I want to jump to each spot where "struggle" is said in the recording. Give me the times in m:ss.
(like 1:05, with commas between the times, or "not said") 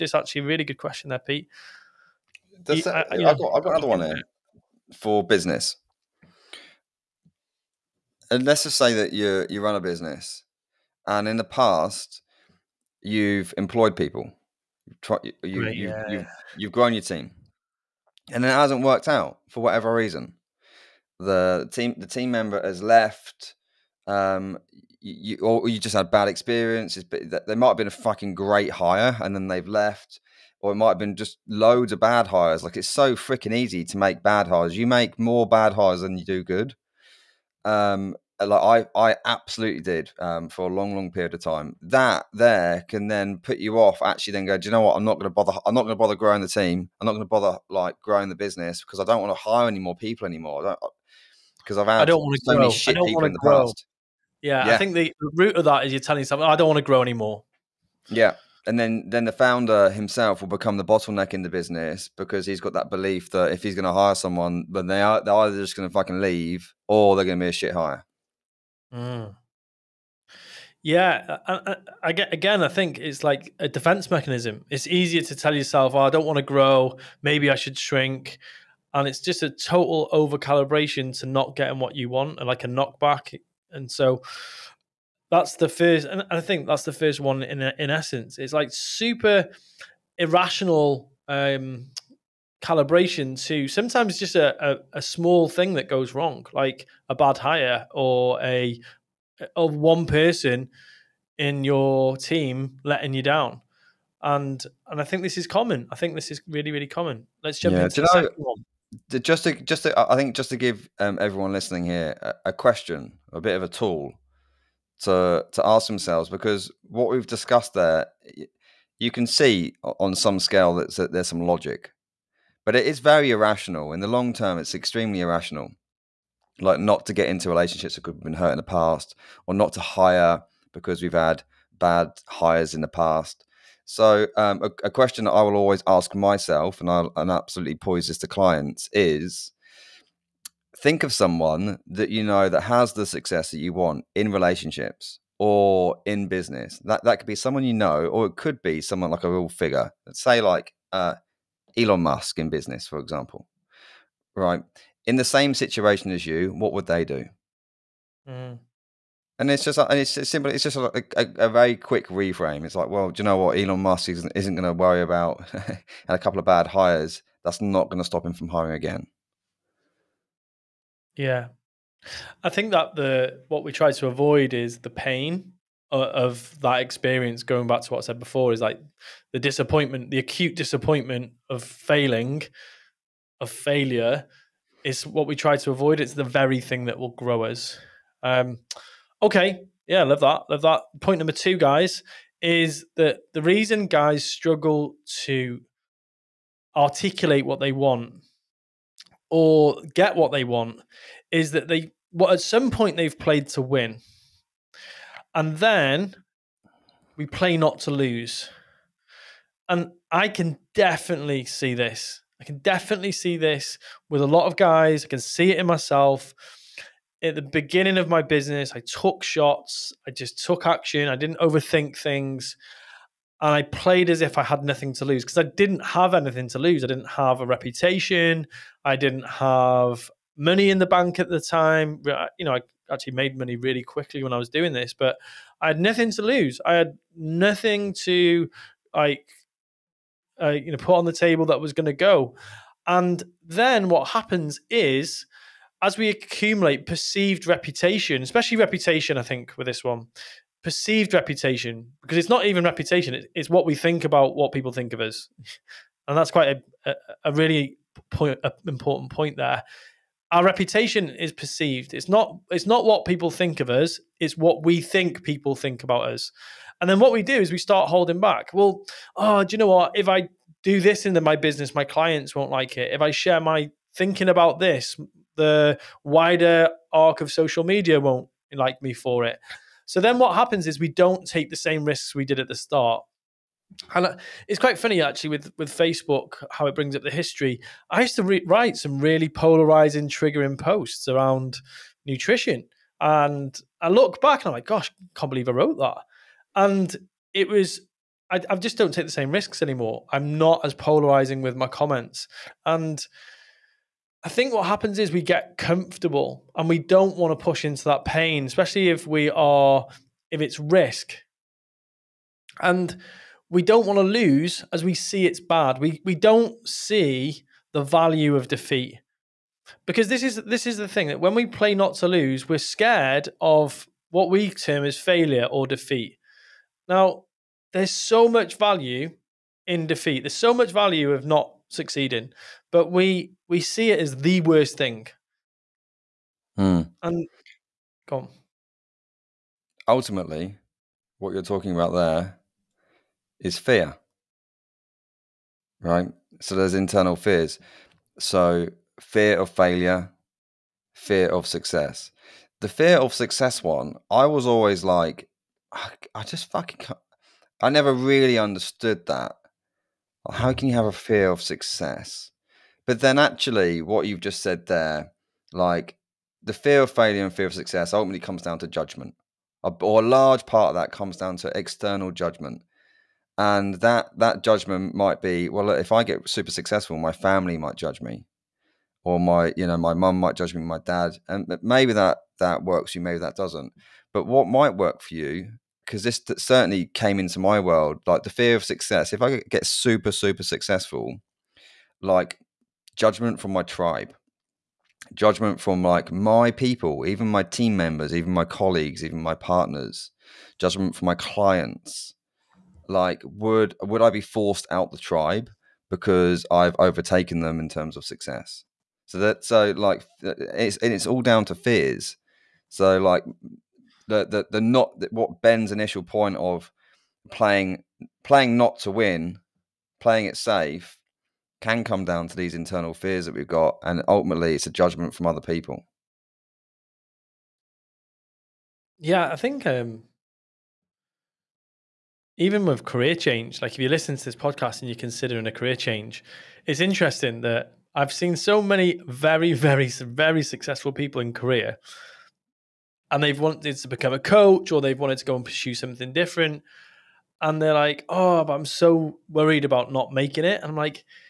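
3:14.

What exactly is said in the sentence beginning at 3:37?
At the beginning of my business, I took shots, I just took action, I didn't overthink things.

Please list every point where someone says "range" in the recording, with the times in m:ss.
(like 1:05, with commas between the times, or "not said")
not said.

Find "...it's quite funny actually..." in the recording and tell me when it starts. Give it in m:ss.
4:44.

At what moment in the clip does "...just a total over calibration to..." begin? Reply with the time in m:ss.
1:19.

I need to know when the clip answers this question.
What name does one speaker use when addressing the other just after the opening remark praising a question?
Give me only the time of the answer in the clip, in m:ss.
0:01.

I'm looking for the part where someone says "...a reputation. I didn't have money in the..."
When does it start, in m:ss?
3:47.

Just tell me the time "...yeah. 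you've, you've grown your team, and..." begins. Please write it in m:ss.
0:15.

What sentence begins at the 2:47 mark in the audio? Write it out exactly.
That's not going to stop him from hiring again.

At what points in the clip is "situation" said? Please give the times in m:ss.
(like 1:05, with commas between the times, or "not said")
2:35.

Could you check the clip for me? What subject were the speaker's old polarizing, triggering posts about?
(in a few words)
Nutrition.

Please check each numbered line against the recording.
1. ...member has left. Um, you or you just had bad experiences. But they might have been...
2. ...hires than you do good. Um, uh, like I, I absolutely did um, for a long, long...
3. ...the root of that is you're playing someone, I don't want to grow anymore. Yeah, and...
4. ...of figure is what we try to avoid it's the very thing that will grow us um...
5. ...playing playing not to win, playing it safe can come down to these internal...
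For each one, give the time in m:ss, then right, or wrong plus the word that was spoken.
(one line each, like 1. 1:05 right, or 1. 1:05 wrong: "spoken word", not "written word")
1. 0:22 right
2. 0:35 right
3. 0:54 wrong: "telling", not "playing"
4. 3:03 wrong: "failure", not "figure"
5. 6:57 right.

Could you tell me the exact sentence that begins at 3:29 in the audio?
And I can definitely see this.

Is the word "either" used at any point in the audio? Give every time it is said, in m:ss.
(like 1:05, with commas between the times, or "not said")
1:05.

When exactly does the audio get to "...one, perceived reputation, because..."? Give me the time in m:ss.
4:09.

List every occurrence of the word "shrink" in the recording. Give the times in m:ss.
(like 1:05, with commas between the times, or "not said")
1:17.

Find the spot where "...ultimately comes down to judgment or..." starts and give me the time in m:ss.
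6:07.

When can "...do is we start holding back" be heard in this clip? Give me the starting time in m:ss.
4:27.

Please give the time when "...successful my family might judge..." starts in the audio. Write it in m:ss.
6:16.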